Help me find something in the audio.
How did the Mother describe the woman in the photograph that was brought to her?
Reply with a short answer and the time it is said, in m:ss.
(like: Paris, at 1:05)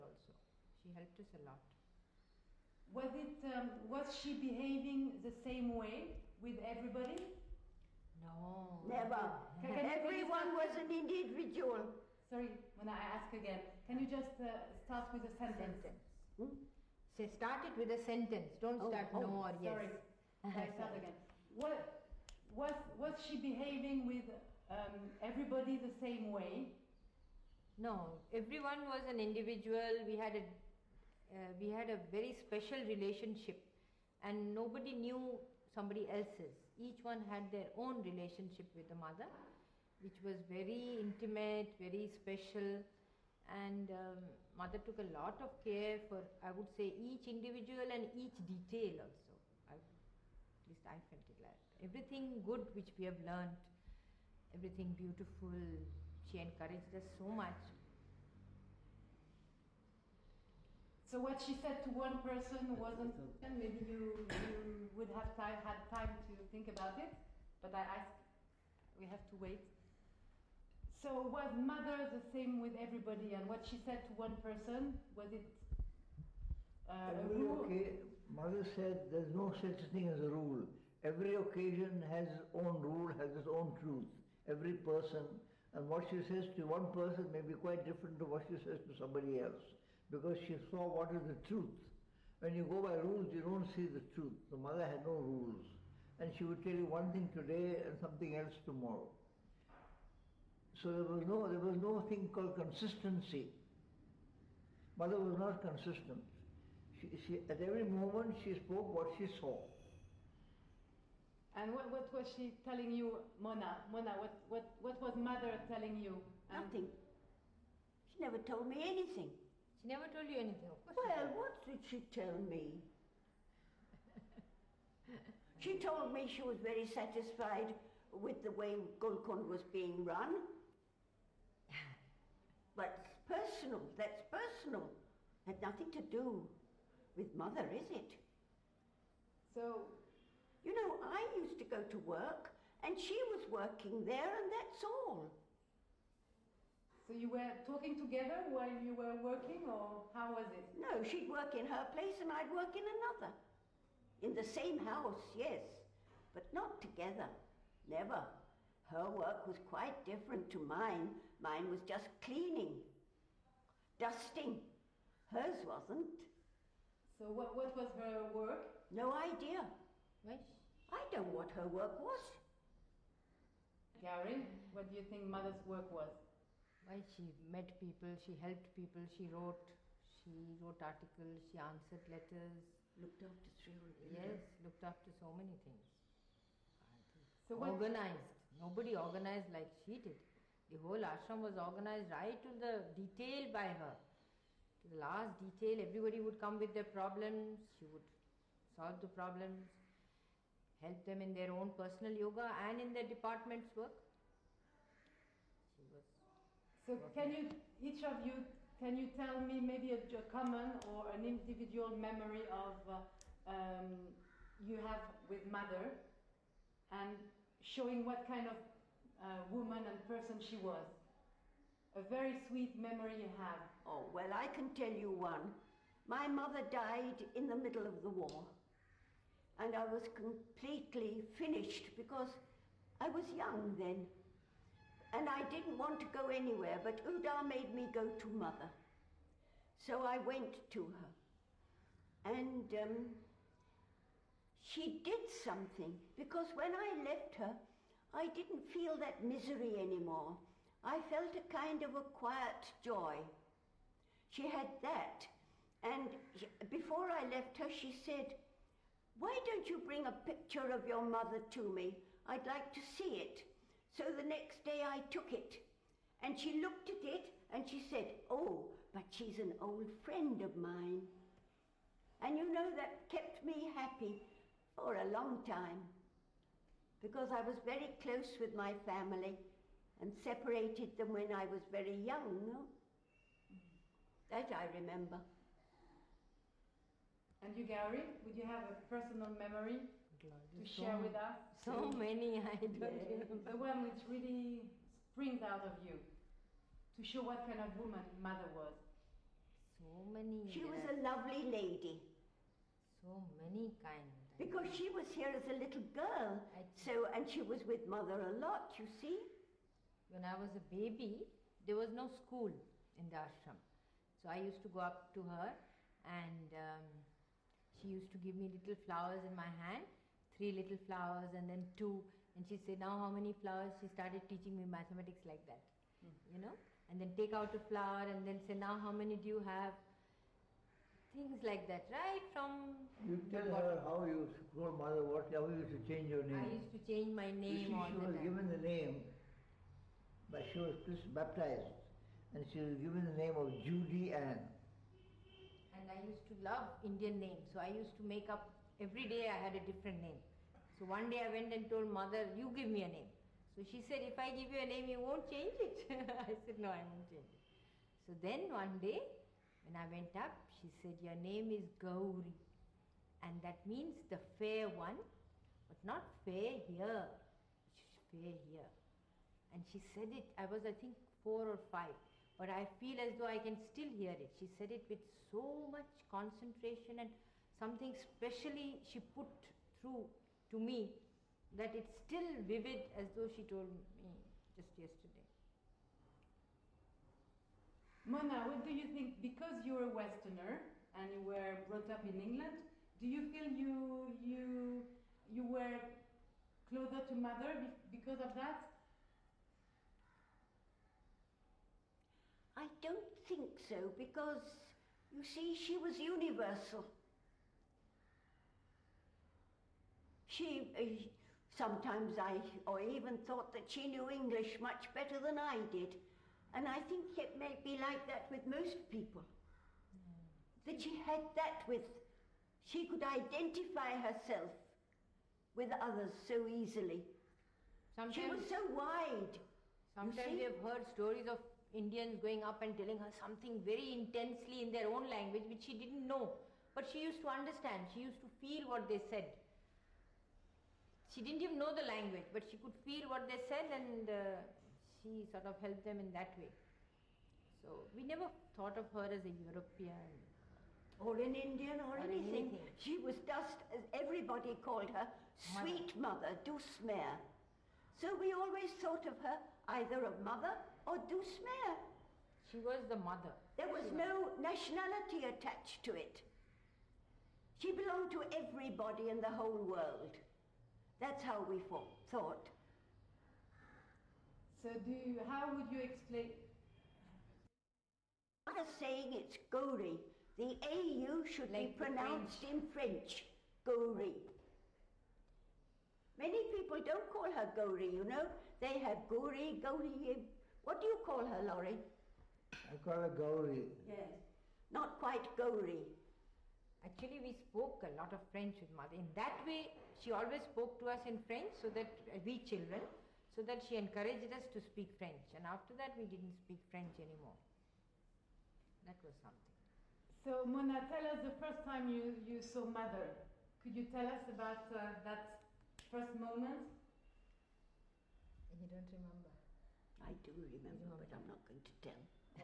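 an old friend, at 4:29.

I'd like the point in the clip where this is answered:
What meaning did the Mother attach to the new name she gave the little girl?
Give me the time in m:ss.
6:04.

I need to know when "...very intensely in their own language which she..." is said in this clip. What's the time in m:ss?
7:13.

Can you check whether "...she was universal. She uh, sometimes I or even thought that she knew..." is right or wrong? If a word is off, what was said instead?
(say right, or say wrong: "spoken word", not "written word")
right.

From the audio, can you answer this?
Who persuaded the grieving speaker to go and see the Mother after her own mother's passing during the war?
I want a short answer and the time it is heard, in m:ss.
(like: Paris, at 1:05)
Udar, at 3:57.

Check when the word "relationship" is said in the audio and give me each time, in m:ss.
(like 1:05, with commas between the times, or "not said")
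0:32, 0:38.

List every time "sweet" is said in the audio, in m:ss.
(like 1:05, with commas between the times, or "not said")
3:42, 7:35.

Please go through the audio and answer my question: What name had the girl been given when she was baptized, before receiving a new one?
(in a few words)
Judy Ann.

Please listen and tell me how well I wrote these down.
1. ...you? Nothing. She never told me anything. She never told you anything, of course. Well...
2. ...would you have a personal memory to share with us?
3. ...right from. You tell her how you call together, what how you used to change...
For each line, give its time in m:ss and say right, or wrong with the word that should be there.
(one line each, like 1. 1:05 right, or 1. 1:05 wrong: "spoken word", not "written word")
1. 1:55 right
2. 4:48 right
3. 5:31 wrong: "mother", not "together".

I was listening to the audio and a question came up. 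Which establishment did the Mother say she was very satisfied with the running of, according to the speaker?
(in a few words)
Golconde.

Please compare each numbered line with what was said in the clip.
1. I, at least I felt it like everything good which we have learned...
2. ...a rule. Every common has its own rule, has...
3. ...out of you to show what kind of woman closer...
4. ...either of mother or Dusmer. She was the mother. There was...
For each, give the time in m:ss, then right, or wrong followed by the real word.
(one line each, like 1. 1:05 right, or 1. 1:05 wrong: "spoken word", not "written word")
1. 0:49 right
2. 1:20 wrong: "occasion", not "common"
3. 4:55 wrong: "mother", not "closer"
4. 7:39 right.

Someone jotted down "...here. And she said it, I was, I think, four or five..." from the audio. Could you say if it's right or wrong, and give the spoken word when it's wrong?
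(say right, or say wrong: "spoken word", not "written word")
right.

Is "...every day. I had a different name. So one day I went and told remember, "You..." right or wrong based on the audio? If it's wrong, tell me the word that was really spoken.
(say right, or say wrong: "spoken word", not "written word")
wrong: "mother", not "remember".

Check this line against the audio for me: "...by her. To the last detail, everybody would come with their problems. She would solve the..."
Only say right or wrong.
right.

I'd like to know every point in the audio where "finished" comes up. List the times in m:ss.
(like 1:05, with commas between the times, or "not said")
3:51.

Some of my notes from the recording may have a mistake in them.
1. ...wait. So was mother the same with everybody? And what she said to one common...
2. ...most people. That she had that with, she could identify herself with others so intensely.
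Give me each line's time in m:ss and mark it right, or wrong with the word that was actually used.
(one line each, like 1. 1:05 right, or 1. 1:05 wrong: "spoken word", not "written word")
1. 1:09 wrong: "person", not "common"
2. 6:58 wrong: "easily", not "intensely".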